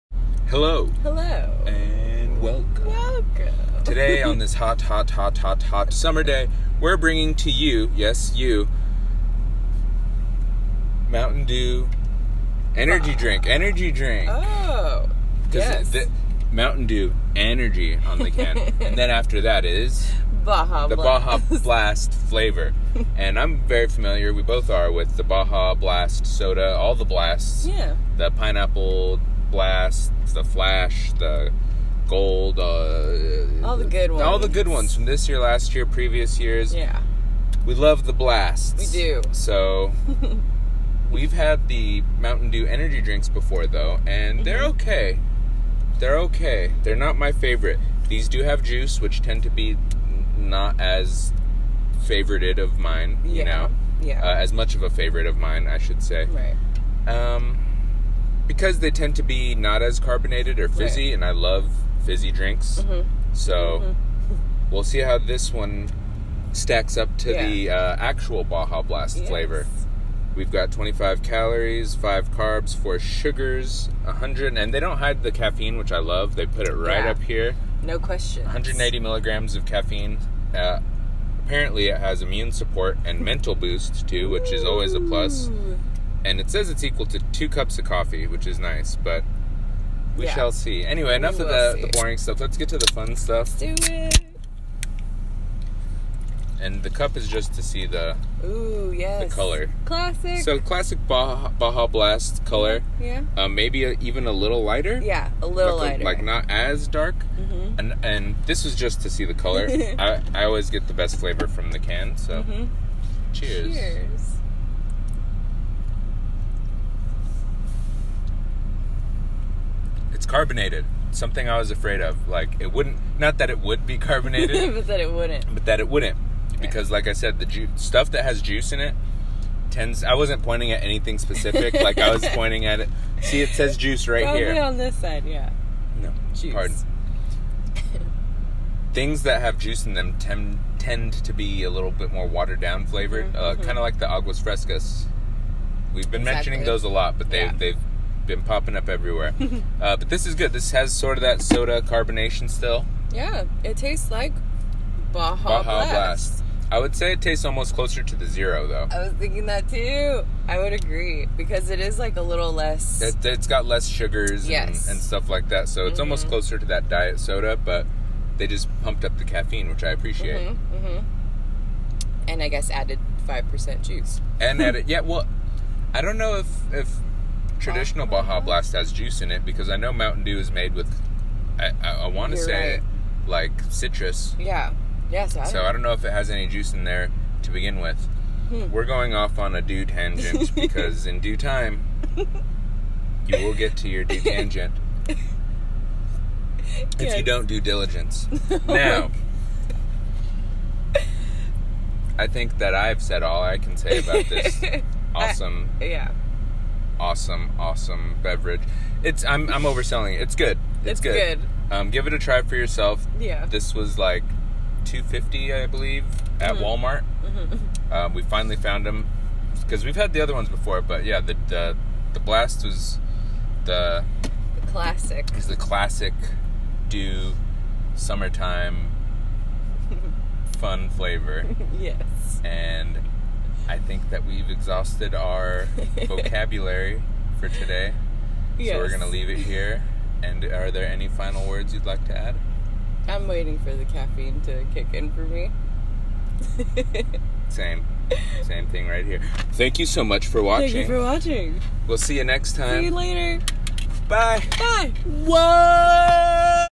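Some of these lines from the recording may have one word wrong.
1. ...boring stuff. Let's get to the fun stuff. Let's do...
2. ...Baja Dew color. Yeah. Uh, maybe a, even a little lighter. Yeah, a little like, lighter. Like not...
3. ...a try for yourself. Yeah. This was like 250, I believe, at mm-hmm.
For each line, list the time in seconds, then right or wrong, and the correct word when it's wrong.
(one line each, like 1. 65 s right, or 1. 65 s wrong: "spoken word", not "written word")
1. 91 s right
2. 101 s wrong: "Blast", not "Dew"
3. 212 s right.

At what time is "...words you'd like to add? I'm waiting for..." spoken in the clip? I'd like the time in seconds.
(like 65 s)
241 s.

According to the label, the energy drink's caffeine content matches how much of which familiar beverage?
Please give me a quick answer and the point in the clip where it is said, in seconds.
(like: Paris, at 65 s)
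2 cups of coffee, at 87 s.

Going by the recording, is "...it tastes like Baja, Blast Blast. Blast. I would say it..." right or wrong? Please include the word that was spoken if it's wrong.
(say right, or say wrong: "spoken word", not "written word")
wrong: "Baja", not "Blast".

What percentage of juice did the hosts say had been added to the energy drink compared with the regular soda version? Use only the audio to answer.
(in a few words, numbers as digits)
5%.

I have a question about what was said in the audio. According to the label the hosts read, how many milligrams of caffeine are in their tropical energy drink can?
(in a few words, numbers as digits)
180.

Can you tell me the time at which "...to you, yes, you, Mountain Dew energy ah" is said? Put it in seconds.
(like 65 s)
7 s.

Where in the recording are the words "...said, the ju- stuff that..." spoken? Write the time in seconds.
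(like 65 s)
127 s.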